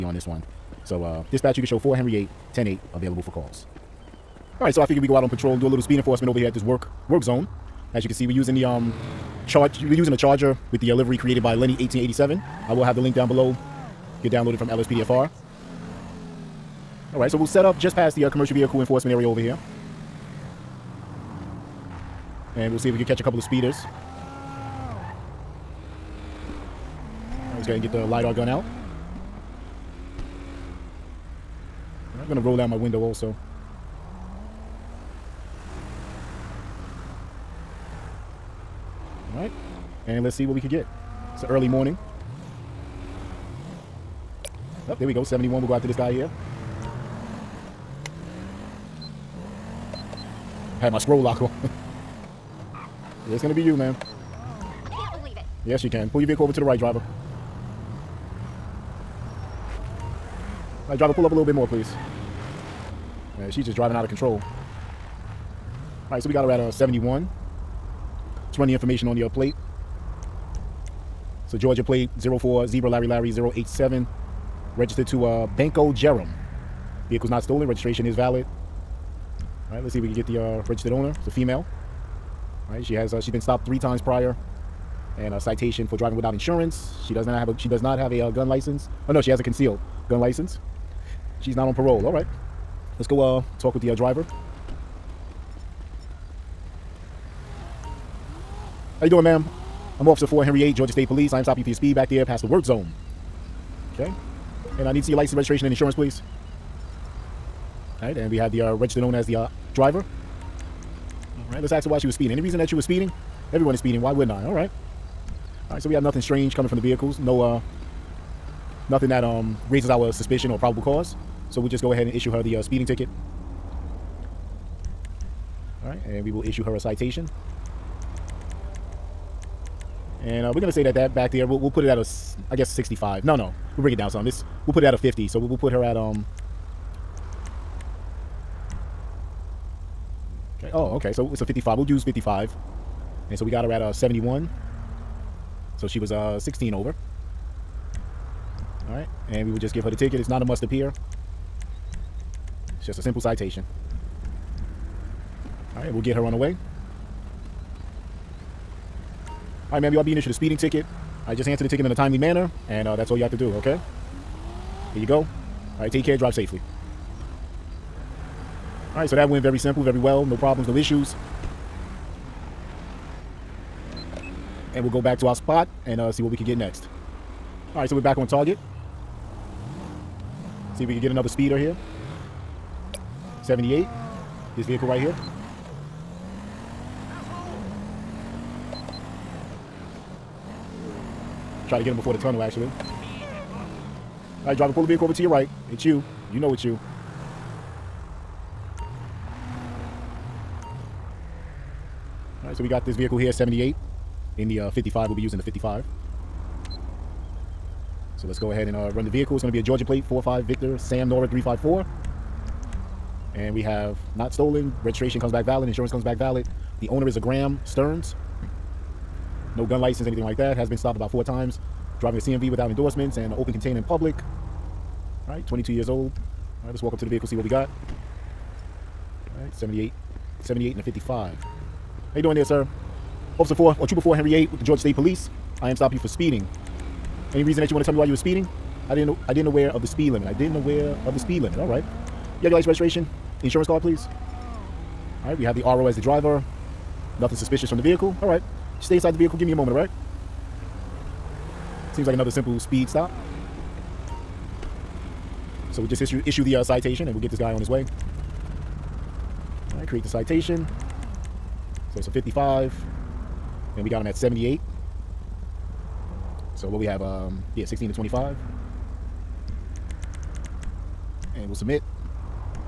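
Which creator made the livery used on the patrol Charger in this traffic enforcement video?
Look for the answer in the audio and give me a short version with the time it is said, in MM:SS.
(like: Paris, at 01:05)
Lenny 1887, at 00:11.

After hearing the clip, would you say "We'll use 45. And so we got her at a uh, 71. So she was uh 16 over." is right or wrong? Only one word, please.
wrong.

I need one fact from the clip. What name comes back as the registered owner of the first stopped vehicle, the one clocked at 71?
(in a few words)
Banco Jerem.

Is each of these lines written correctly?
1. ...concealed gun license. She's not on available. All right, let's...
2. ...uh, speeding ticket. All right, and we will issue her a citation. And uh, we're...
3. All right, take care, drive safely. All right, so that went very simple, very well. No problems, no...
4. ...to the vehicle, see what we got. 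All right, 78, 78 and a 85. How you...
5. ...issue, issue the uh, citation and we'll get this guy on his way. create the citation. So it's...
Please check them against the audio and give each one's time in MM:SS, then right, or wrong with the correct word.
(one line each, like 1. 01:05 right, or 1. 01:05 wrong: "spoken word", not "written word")
1. 01:29 wrong: "parole", not "available"
2. 02:02 right
3. 02:45 right
4. 03:46 wrong: "55", not "85"
5. 04:16 right.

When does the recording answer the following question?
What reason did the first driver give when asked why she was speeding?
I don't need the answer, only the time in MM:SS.
01:53.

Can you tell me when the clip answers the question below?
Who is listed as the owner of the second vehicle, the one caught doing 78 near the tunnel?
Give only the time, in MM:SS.
03:37.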